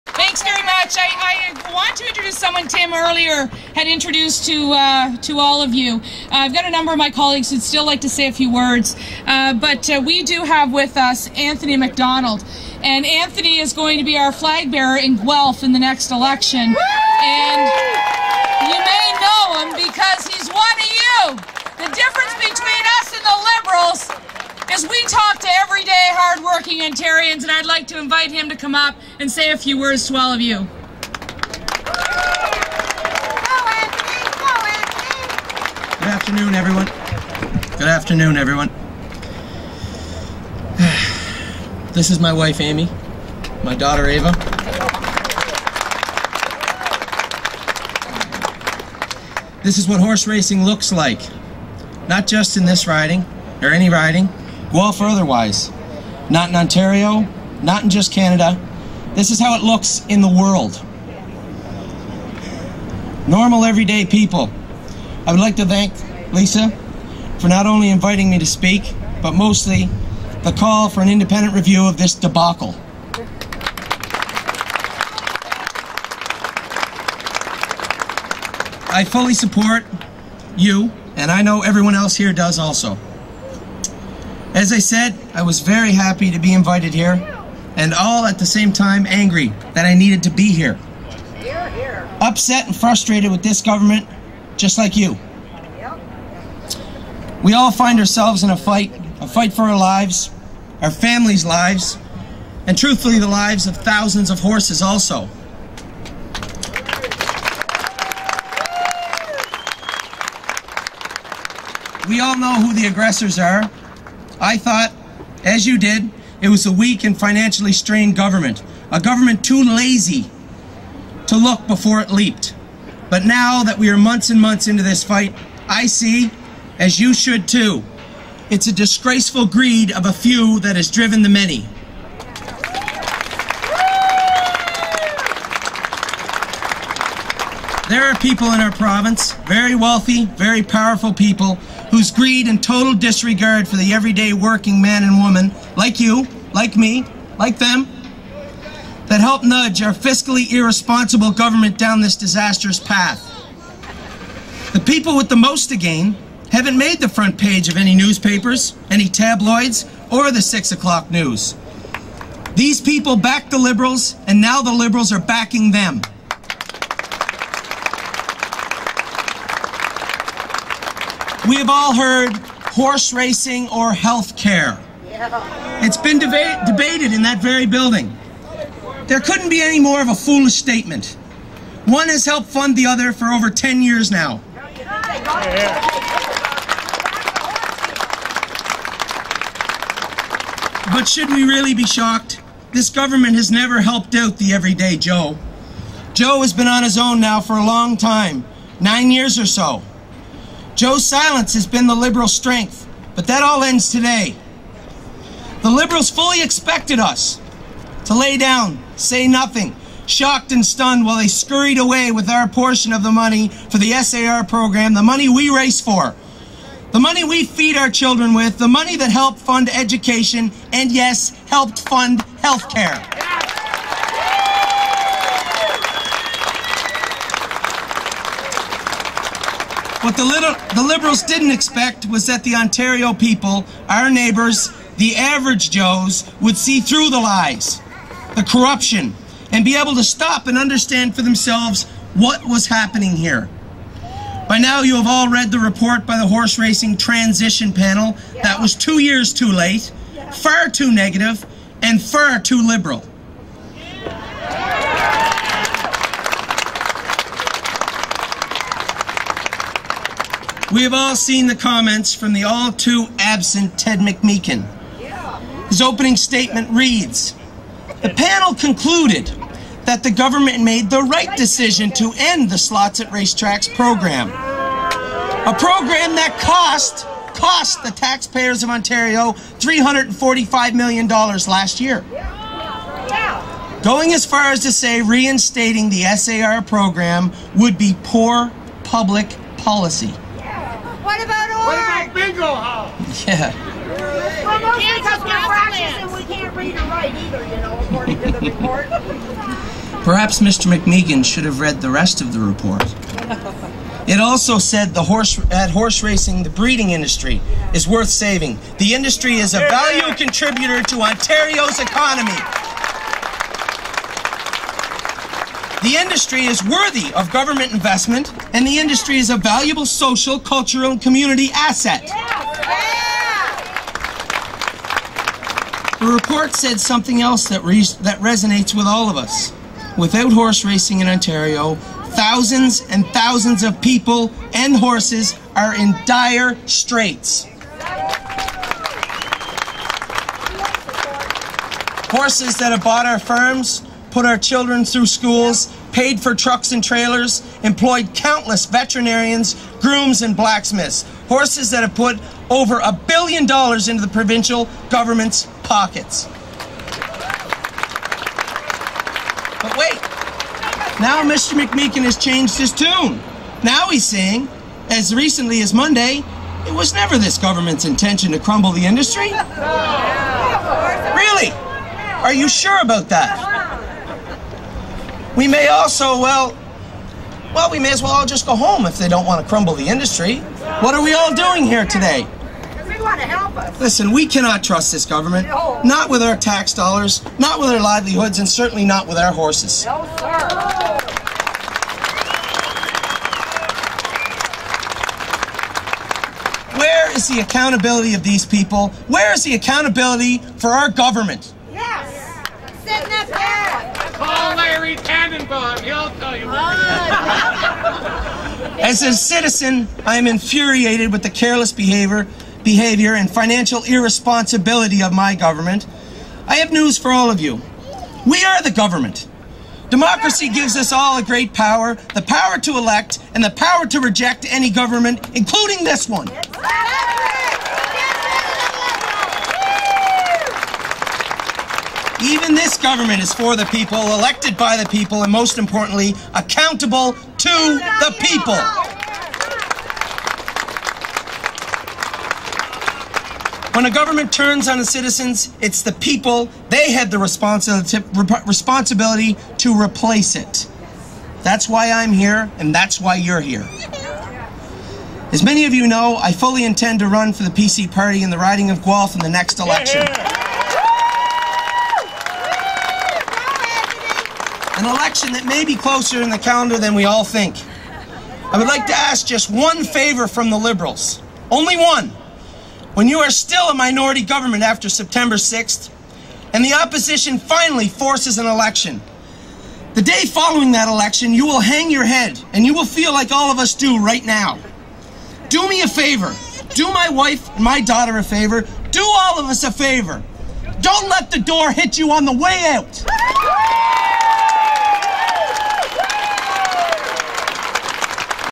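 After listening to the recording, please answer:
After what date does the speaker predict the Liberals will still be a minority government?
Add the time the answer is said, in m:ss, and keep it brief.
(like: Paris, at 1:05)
September 6, at 7:54.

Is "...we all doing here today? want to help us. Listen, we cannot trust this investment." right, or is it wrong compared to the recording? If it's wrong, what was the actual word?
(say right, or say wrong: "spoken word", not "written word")
wrong: "government", not "investment".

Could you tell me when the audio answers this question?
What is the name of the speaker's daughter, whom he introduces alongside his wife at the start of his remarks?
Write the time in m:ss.
0:44.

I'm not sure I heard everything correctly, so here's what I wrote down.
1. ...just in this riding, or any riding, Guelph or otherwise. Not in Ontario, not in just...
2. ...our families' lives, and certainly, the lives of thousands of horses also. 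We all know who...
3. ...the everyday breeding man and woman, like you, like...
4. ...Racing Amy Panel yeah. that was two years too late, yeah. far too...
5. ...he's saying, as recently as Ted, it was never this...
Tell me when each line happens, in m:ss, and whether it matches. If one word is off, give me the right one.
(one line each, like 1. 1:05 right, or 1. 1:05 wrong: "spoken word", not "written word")
1. 0:52 right
2. 1:40 wrong: "truthfully", not "certainly"
3. 2:23 wrong: "working", not "breeding"
4. 4:06 wrong: "Transition", not "Amy"
5. 6:03 wrong: "Monday", not "Ted".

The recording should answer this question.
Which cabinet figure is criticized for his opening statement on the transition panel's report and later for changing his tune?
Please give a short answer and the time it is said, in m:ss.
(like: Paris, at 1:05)
Ted McMeekin, at 4:23.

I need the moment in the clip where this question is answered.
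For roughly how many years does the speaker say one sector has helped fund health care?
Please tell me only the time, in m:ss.
3:03.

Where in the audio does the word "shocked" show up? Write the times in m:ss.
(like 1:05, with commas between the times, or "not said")
3:11, 3:30.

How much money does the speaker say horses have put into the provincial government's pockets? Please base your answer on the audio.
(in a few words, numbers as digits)
over a billion dollars.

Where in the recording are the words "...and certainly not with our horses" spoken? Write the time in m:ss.
6:28.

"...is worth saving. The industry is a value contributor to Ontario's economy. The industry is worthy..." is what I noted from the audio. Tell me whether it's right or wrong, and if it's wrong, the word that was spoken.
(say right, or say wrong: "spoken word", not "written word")
right.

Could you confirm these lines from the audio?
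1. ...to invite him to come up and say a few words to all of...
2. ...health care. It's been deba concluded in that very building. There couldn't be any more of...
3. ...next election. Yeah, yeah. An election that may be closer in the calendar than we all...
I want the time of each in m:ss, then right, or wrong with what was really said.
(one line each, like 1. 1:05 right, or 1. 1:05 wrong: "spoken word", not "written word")
1. 0:27 right
2. 2:53 wrong: "debated", not "concluded"
3. 7:39 right.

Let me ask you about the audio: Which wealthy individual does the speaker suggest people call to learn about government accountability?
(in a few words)
Larry Tanenbaum.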